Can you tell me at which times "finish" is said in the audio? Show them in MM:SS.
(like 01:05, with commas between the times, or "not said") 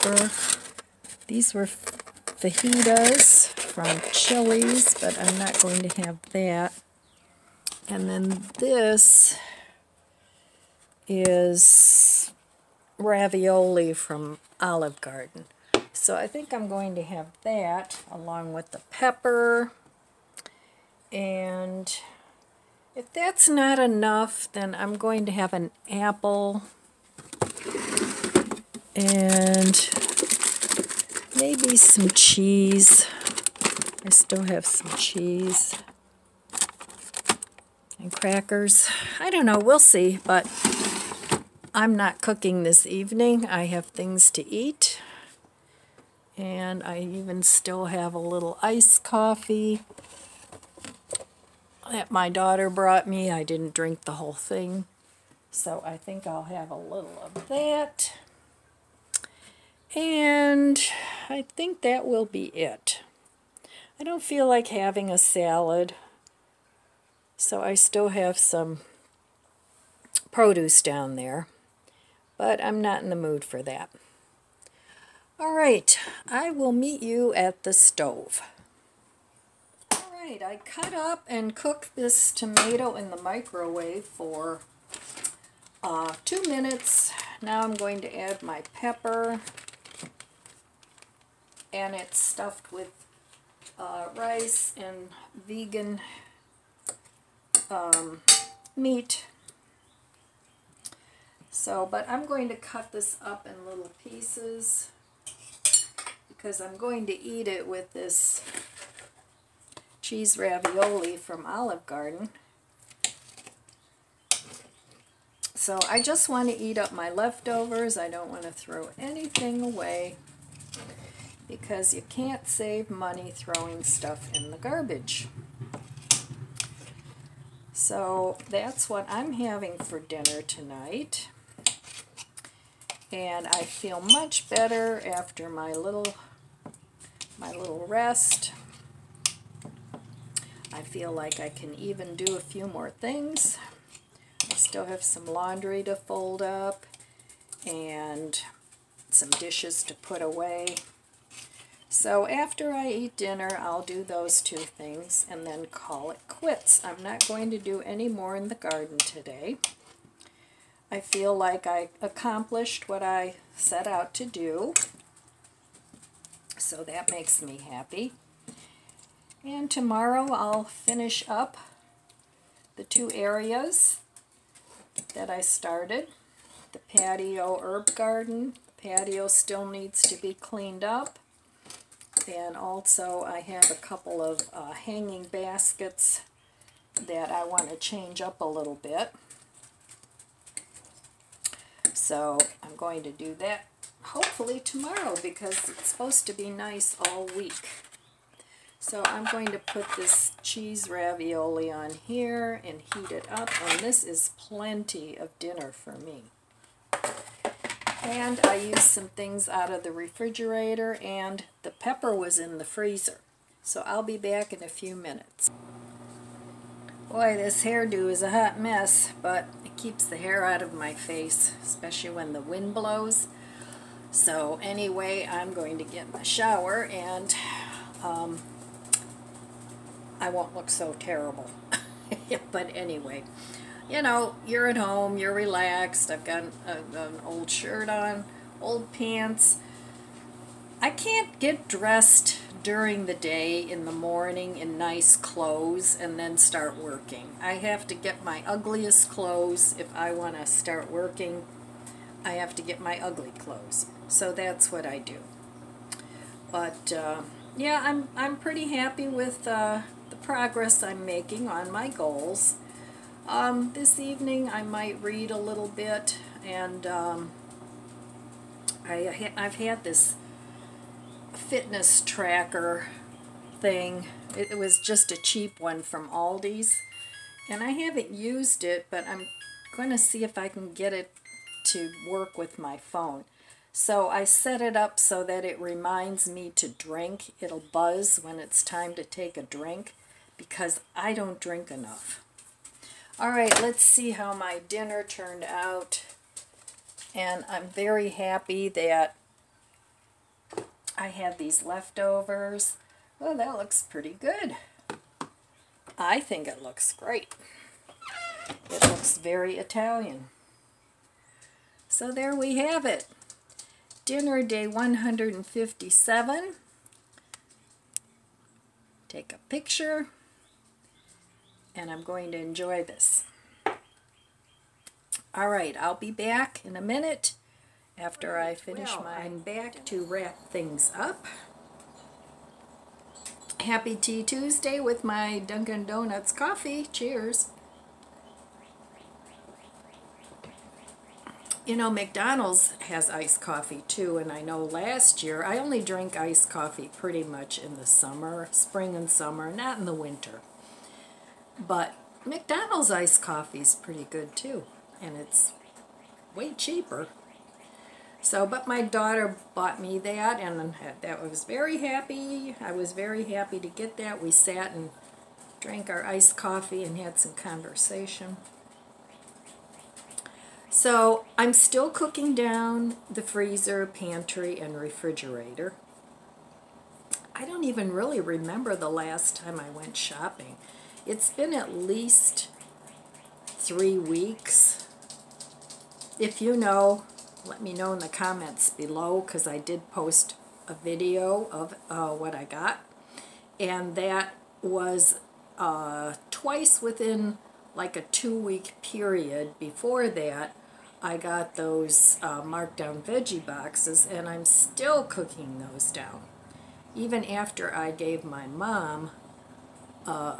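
02:50, 05:28.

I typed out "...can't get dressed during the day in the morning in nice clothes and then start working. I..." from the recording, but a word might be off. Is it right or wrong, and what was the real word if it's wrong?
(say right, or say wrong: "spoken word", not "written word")
right.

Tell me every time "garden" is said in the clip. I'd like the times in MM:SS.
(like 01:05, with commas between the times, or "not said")
00:15, 01:51, 02:38, 02:57.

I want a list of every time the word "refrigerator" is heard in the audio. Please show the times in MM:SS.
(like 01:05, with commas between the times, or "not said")
03:29, 06:14.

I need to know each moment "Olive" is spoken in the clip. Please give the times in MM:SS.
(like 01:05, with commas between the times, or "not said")
00:14, 01:51.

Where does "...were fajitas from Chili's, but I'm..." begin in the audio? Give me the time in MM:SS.
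00:01.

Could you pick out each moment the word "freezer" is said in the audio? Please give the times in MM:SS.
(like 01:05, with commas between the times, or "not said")
03:32, 06:13.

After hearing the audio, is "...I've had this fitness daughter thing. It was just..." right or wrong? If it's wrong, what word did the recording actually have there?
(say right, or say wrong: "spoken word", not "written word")
wrong: "tracker", not "daughter".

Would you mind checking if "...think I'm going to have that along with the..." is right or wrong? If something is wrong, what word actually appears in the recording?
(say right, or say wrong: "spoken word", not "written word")
right.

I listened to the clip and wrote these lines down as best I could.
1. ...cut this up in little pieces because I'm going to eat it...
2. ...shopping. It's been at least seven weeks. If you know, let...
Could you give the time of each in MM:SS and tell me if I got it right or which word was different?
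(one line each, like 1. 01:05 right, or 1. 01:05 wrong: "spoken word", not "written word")
1. 01:42 right
2. 06:19 wrong: "three", not "seven".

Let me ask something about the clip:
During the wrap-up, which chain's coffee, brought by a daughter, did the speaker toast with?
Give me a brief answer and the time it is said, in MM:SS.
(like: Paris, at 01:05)
Dunkin' Donuts, at 05:35.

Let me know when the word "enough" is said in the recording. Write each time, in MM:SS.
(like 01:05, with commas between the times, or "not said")
00:23, 04:51.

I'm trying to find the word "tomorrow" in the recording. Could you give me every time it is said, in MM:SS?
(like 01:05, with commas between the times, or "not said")
02:49, 03:14.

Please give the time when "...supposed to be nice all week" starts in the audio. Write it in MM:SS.
03:15.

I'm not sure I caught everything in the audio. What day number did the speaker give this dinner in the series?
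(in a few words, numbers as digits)
157.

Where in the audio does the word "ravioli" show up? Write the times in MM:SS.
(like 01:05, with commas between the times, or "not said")
00:12, 01:50, 03:20.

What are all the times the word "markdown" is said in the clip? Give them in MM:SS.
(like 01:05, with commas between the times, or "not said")
06:42.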